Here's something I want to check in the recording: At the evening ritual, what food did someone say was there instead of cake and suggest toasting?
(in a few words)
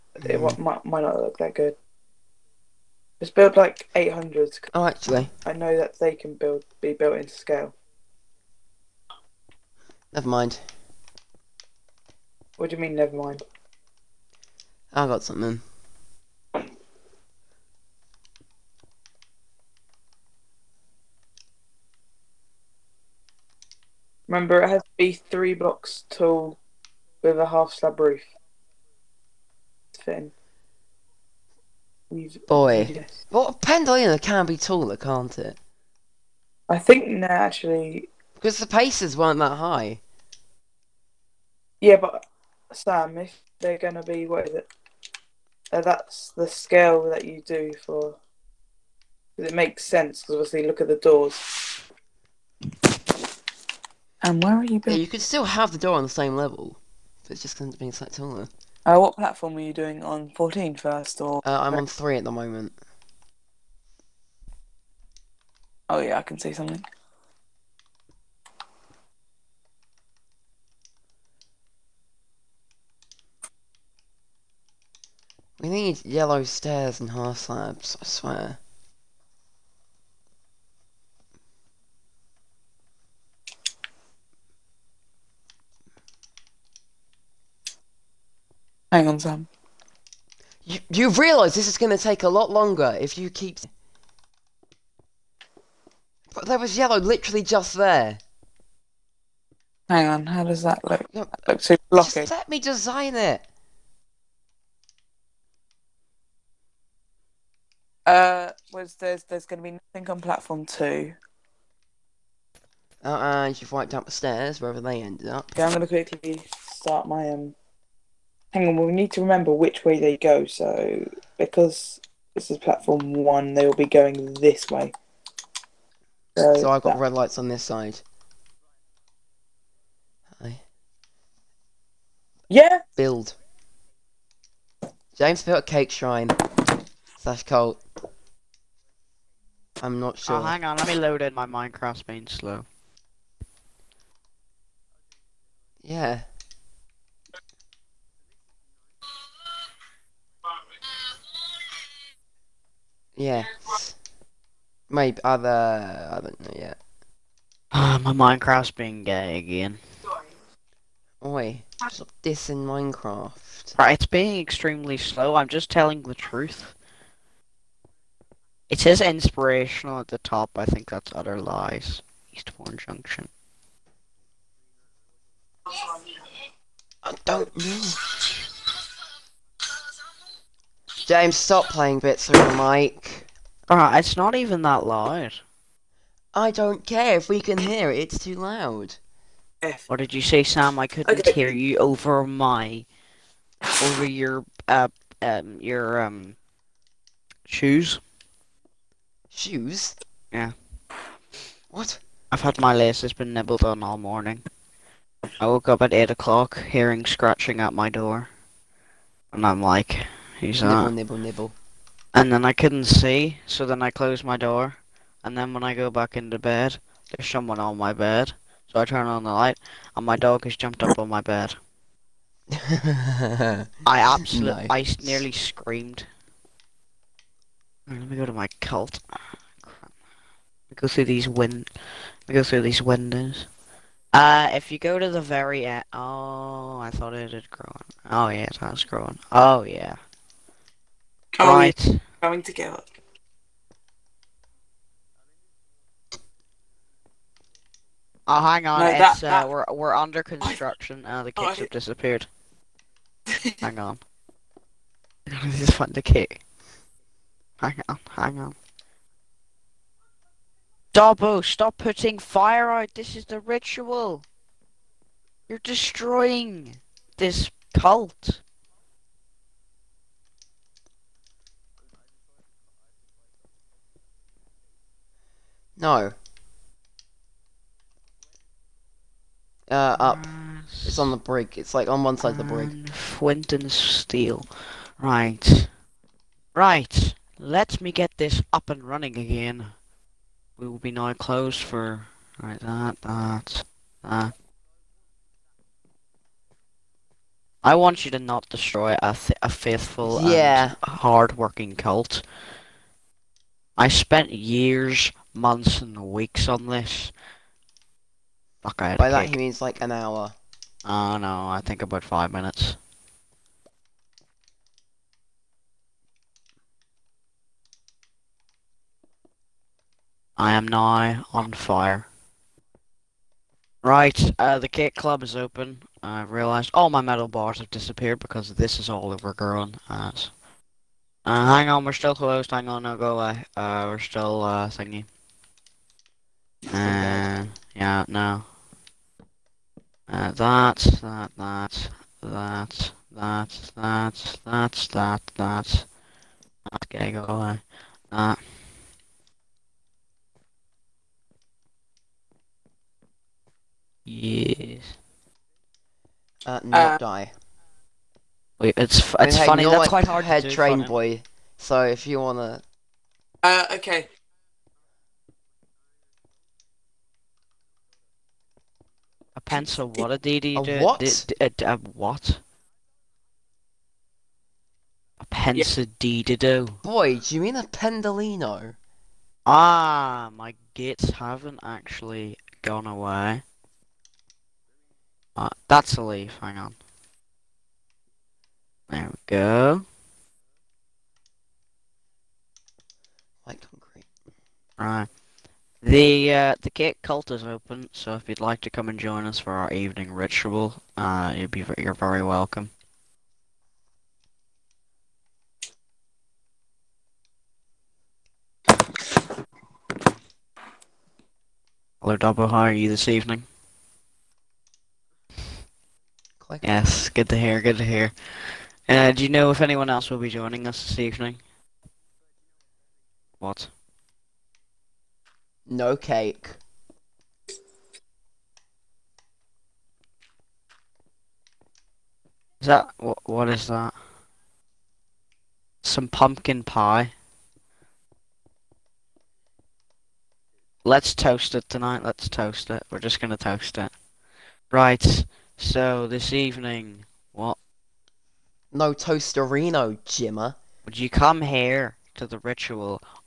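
Pumpkin pie.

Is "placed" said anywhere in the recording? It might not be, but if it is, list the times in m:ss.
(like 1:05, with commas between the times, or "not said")
not said.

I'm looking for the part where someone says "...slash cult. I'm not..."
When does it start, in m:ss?
2:17.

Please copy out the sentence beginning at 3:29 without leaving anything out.
And I'm like Who's nibble, that?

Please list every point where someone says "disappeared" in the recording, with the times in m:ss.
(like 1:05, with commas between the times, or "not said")
4:11, 5:27.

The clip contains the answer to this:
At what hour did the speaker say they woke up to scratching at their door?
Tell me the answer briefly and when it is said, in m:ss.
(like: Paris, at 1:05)
8 o'clock, at 3:25.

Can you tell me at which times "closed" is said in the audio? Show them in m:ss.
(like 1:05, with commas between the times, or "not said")
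3:33, 4:51, 5:32.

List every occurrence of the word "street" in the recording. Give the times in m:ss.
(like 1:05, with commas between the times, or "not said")
not said.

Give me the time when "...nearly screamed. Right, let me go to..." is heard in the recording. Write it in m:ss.
3:45.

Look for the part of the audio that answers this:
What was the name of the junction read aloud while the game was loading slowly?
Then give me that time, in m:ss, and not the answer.
2:52.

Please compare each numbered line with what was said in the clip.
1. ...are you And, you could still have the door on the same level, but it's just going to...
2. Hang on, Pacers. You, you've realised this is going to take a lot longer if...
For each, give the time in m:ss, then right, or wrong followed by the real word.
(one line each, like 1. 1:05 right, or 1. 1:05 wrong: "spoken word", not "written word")
1. 0:54 wrong: "Yeah", not "And"
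2. 1:28 wrong: "Sam", not "Pacers".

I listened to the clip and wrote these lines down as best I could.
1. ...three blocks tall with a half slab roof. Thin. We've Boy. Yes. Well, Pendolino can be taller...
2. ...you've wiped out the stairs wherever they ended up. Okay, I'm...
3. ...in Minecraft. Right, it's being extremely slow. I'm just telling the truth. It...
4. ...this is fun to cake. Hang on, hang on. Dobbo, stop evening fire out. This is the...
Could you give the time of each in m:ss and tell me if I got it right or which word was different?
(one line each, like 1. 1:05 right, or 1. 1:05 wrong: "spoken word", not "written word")
1. 0:25 right
2. 1:53 right
3. 2:42 right
4. 4:15 wrong: "putting", not "evening".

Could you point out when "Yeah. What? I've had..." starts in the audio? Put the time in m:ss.
3:20.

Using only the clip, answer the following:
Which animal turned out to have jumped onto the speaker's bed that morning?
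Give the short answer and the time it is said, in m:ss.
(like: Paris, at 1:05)
Dog, at 3:40.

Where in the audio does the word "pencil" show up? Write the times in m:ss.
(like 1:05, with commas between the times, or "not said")
6:09, 6:15.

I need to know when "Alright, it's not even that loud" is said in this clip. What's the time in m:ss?
3:03.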